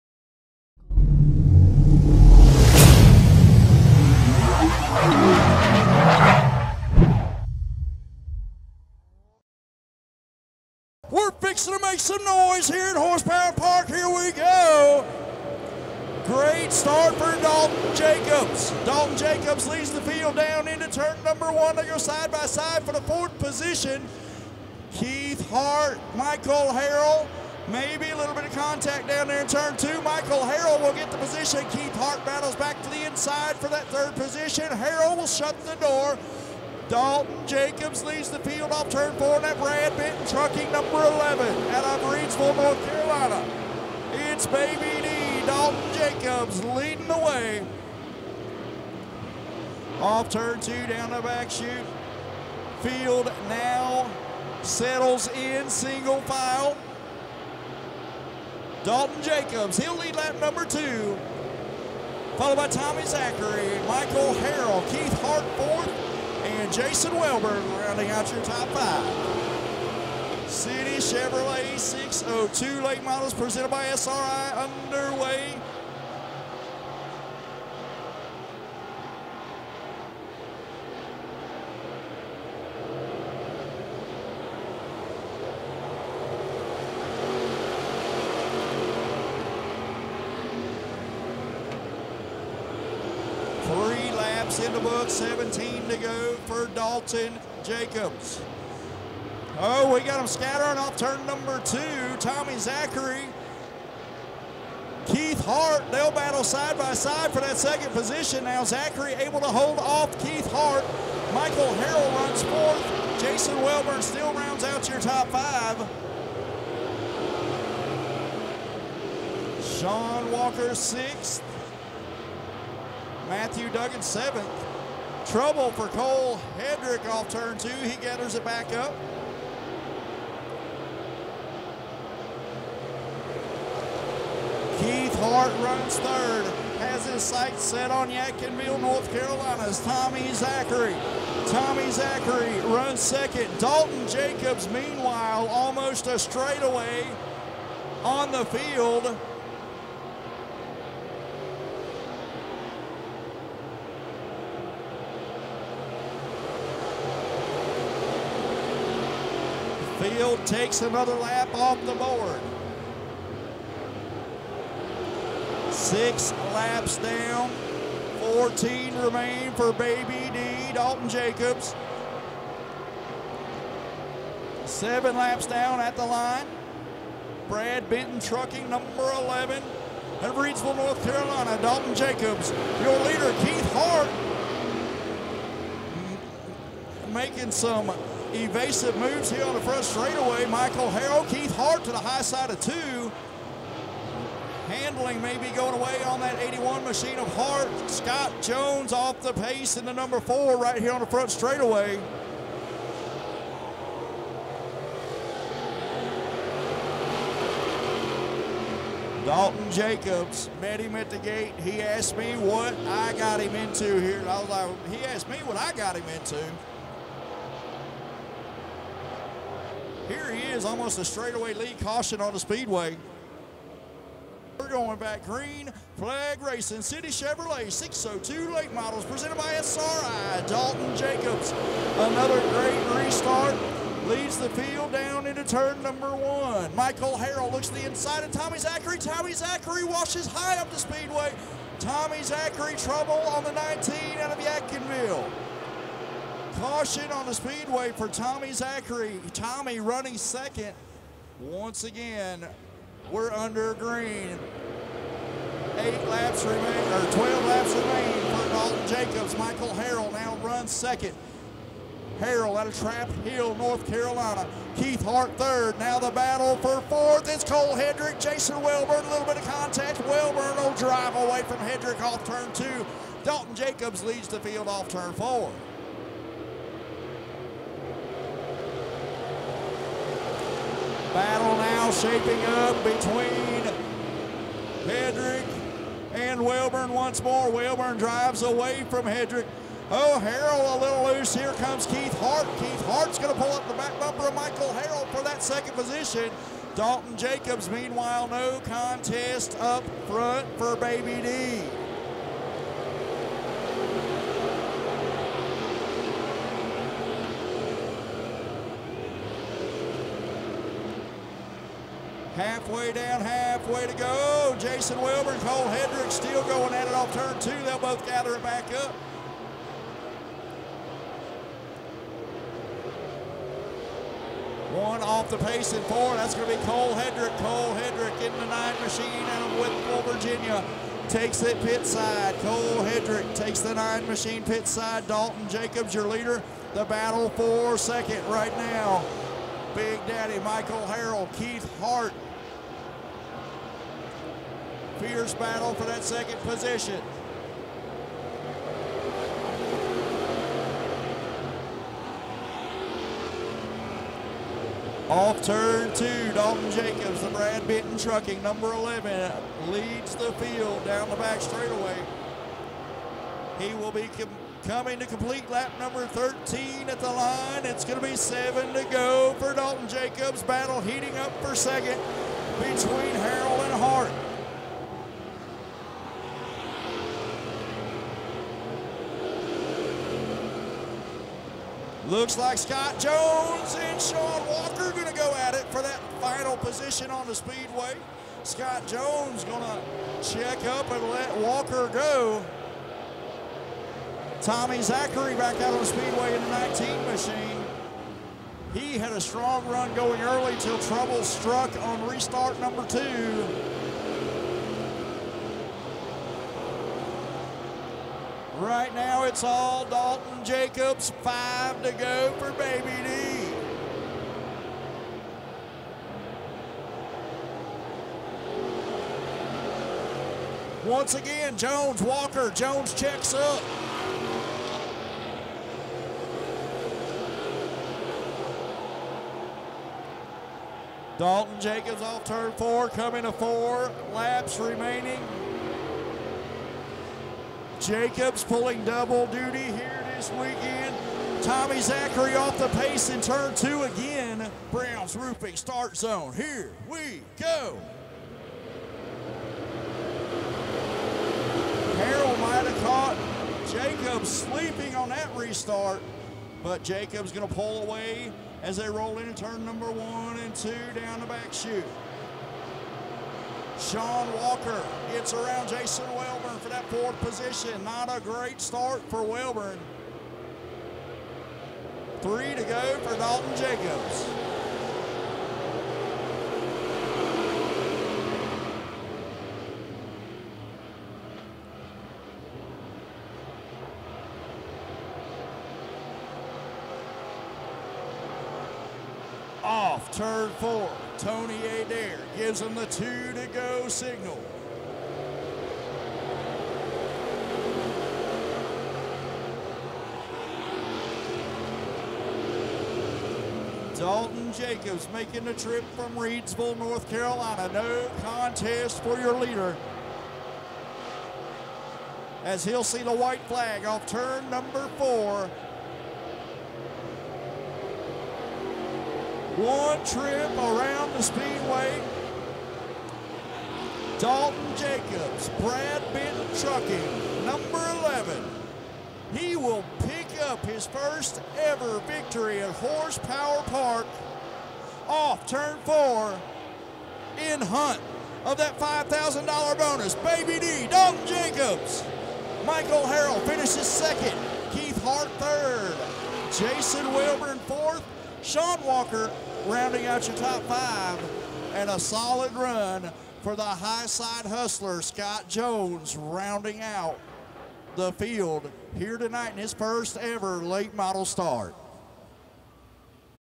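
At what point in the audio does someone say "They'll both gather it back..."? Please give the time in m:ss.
5:17.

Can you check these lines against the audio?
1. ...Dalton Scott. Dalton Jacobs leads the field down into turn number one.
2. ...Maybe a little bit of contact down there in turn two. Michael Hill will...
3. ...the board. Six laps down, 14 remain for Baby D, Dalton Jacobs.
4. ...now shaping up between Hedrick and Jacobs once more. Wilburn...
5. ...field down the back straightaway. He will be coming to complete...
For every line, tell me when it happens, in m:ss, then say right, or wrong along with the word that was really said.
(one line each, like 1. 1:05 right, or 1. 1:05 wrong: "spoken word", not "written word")
1. 0:17 wrong: "Jacobs", not "Scott"
2. 0:27 wrong: "Harrell", not "Hill"
3. 2:41 right
4. 4:41 wrong: "Wilburn", not "Jacobs"
5. 6:00 right.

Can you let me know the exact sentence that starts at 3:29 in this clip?
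Dalton Jacobs met him at the gate.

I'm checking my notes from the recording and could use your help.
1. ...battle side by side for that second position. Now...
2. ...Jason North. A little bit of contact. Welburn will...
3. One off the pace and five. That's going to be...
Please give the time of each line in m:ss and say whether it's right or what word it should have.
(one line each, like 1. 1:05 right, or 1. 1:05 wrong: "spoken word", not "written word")
1. 1:46 right
2. 4:28 wrong: "Welburn", not "North"
3. 5:24 wrong: "four", not "five".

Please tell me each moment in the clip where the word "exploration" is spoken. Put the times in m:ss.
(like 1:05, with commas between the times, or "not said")
not said.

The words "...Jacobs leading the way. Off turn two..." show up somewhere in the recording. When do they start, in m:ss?
0:45.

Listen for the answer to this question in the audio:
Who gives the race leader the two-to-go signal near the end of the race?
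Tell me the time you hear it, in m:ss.
8:11.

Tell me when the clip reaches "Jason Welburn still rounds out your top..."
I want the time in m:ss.
1:53.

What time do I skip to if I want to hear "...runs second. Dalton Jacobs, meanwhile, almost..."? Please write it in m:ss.
2:22.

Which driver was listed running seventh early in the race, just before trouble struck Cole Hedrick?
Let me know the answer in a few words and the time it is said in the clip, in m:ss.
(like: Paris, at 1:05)
Matthew Duggan, at 2:03.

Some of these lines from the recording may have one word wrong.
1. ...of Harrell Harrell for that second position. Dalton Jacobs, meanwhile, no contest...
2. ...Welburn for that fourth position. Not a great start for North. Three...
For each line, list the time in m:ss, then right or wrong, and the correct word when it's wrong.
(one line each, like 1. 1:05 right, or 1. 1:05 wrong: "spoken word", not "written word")
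1. 4:54 wrong: "Michael", not "Harrell"
2. 7:46 wrong: "Welburn", not "North".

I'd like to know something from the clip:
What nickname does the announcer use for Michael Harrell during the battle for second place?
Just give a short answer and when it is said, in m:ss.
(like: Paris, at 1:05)
Big Daddy, at 5:39.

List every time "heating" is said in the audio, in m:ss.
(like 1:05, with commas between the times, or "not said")
6:10.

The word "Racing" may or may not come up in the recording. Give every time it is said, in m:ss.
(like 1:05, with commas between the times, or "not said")
3:46.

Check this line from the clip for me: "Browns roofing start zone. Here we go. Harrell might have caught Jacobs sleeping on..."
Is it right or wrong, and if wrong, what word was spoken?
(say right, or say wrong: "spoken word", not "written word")
right.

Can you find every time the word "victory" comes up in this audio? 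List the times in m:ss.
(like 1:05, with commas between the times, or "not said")
8:52.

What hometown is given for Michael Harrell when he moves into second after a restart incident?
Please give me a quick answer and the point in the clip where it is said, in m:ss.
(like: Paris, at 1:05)
Trap Hill, North Carolina, at 4:22.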